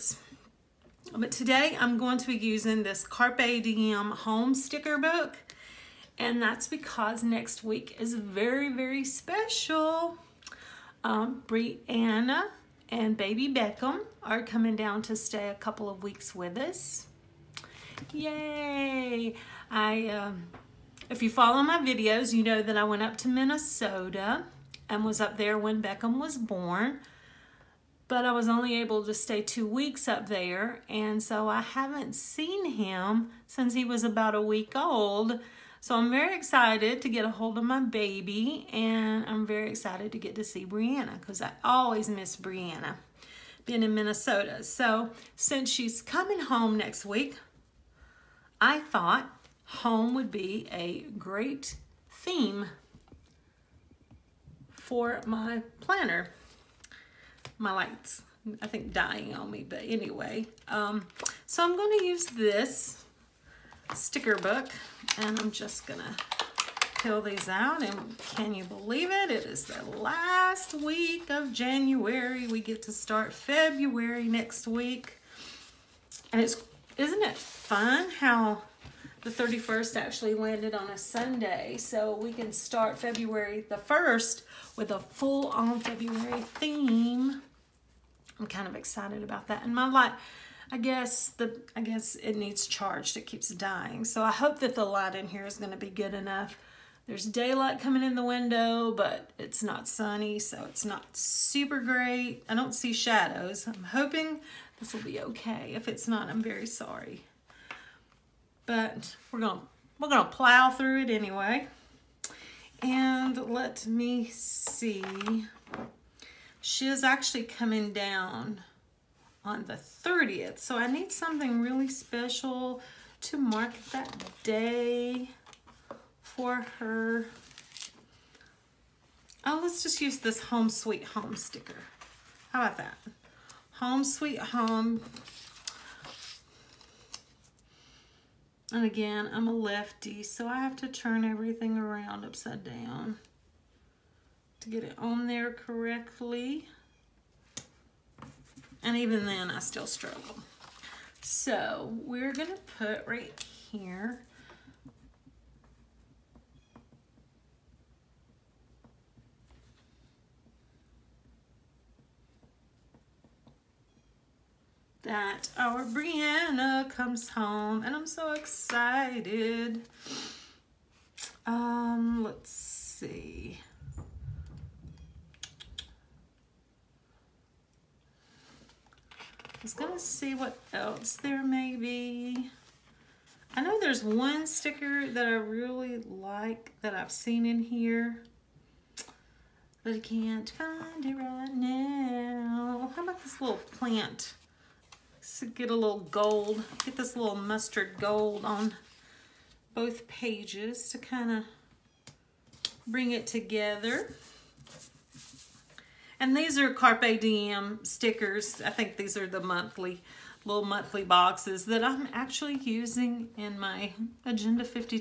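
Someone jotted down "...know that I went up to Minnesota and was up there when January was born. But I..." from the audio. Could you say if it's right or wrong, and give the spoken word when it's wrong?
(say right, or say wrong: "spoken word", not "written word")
wrong: "Beckham", not "January".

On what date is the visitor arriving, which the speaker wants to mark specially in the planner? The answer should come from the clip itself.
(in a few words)
the 30th.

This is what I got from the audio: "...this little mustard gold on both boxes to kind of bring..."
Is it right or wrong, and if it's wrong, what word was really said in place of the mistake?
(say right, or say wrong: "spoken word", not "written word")
wrong: "pages", not "boxes".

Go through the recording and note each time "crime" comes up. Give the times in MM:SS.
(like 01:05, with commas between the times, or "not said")
not said.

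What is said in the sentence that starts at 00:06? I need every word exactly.
And that's because next week is very, very special.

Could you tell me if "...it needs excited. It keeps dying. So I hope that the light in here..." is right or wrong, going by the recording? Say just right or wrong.
wrong.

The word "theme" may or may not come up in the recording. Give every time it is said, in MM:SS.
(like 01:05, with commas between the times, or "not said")
00:52, 01:26.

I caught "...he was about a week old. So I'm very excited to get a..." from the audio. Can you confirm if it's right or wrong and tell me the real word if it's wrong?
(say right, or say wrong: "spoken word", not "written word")
right.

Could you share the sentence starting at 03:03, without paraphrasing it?
I know there's one sticker that I really like that I've seen in here, but I can't find it right now.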